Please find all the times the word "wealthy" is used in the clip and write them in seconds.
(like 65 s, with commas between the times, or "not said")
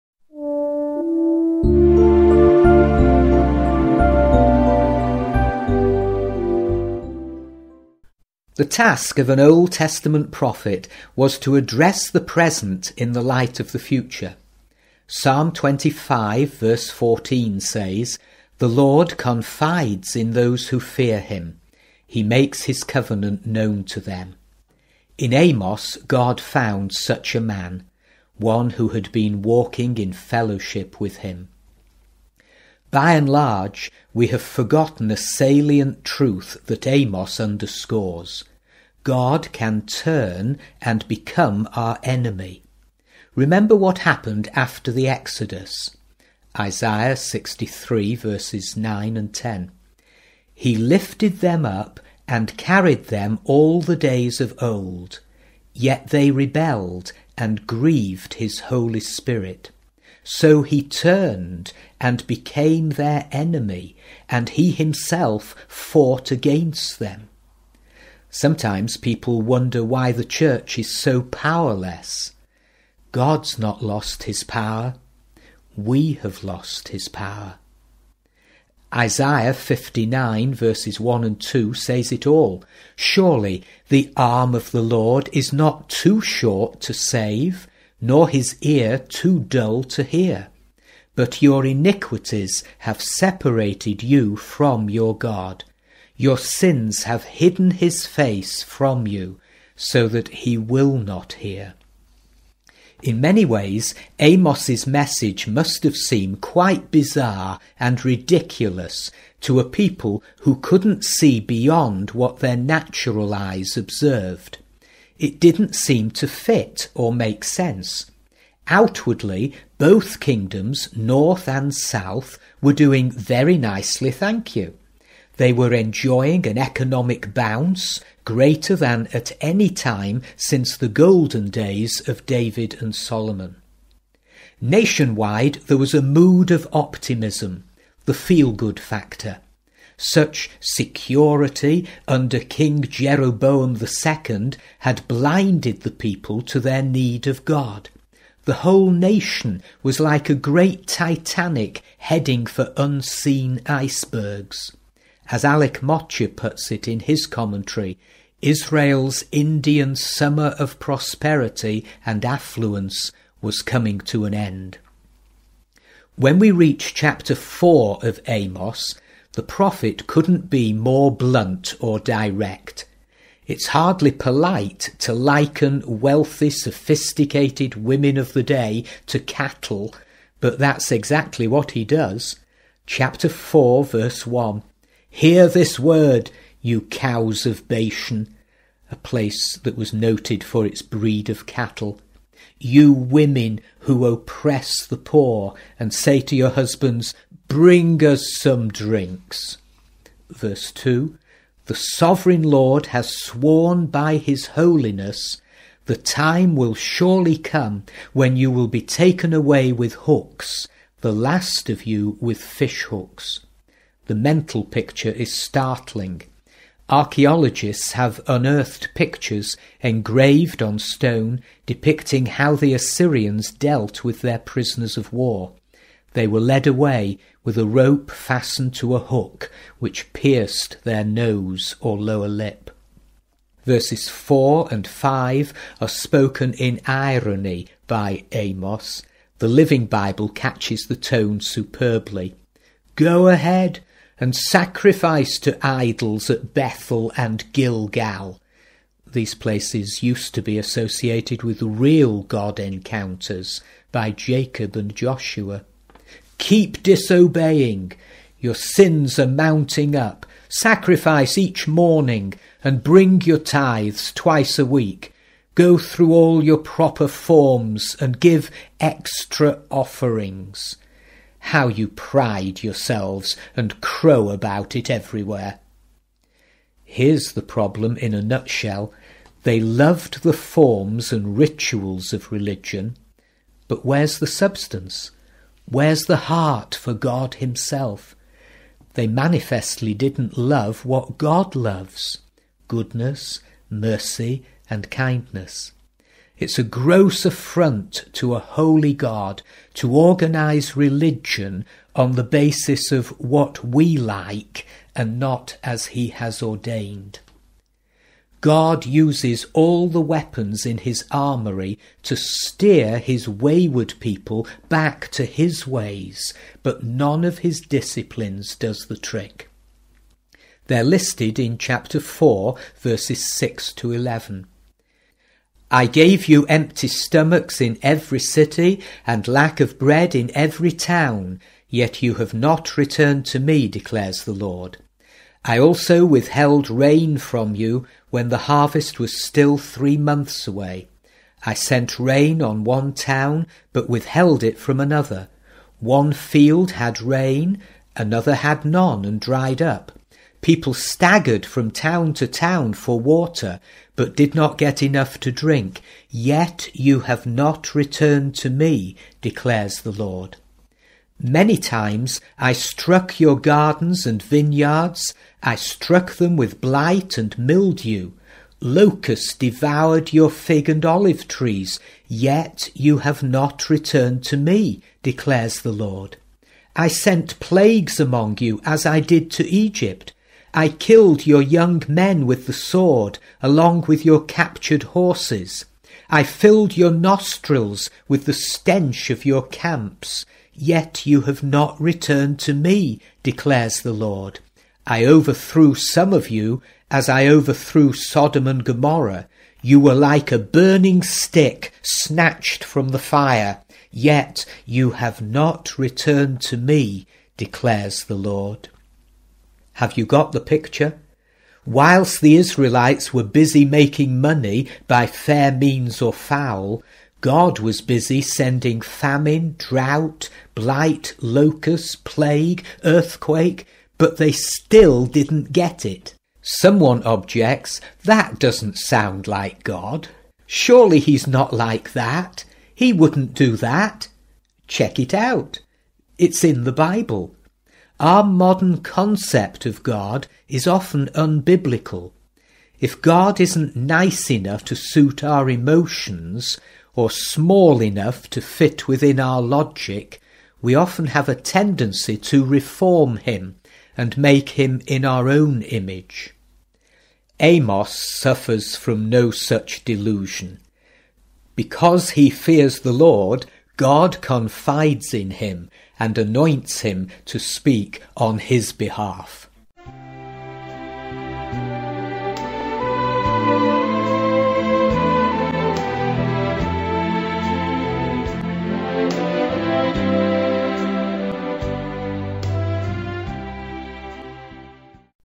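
176 s.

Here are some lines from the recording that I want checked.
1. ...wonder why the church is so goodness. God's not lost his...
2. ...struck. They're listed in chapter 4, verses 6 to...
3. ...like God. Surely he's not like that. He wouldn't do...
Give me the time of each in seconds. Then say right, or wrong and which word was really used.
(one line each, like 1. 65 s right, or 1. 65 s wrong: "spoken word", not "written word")
1. 69 s wrong: "powerless", not "goodness"
2. 318 s wrong: "trick", not "struck"
3. 429 s right.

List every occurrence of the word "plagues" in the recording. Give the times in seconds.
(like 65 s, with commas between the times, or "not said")
377 s, 422 s.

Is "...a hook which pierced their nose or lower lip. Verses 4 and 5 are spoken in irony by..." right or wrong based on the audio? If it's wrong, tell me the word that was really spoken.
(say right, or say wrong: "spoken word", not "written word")
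right.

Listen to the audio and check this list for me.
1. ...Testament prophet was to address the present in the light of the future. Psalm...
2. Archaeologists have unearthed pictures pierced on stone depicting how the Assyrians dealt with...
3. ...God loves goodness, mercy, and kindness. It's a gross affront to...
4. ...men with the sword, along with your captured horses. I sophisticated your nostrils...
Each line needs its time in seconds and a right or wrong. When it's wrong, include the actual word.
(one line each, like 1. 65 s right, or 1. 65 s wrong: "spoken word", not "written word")
1. 9 s right
2. 216 s wrong: "engraved", not "pierced"
3. 291 s right
4. 381 s wrong: "filled", not "sophisticated".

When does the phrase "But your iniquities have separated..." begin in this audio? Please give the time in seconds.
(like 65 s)
91 s.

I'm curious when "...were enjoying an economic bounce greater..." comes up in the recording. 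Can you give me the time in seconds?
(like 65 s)
125 s.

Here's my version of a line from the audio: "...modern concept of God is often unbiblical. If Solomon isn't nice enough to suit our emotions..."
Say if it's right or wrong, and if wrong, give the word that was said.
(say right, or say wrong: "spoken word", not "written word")
wrong: "God", not "Solomon".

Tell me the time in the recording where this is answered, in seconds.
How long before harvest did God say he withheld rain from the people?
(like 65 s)
339 s.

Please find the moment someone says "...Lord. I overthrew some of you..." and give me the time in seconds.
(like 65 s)
393 s.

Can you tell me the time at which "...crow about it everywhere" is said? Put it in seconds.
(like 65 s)
273 s.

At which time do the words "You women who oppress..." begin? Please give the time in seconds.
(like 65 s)
192 s.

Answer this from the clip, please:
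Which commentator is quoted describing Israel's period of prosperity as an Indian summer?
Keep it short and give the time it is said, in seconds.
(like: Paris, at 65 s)
Alec Motyer, at 155 s.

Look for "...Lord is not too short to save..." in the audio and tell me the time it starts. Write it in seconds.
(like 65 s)
84 s.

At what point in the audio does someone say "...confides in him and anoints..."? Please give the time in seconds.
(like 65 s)
464 s.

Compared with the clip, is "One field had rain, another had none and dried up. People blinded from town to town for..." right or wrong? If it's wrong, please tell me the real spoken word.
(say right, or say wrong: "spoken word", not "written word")
wrong: "staggered", not "blinded".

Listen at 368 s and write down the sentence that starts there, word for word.
Locusts devoured your fig and olive trees, yet you have not returned to me, declares the Lord.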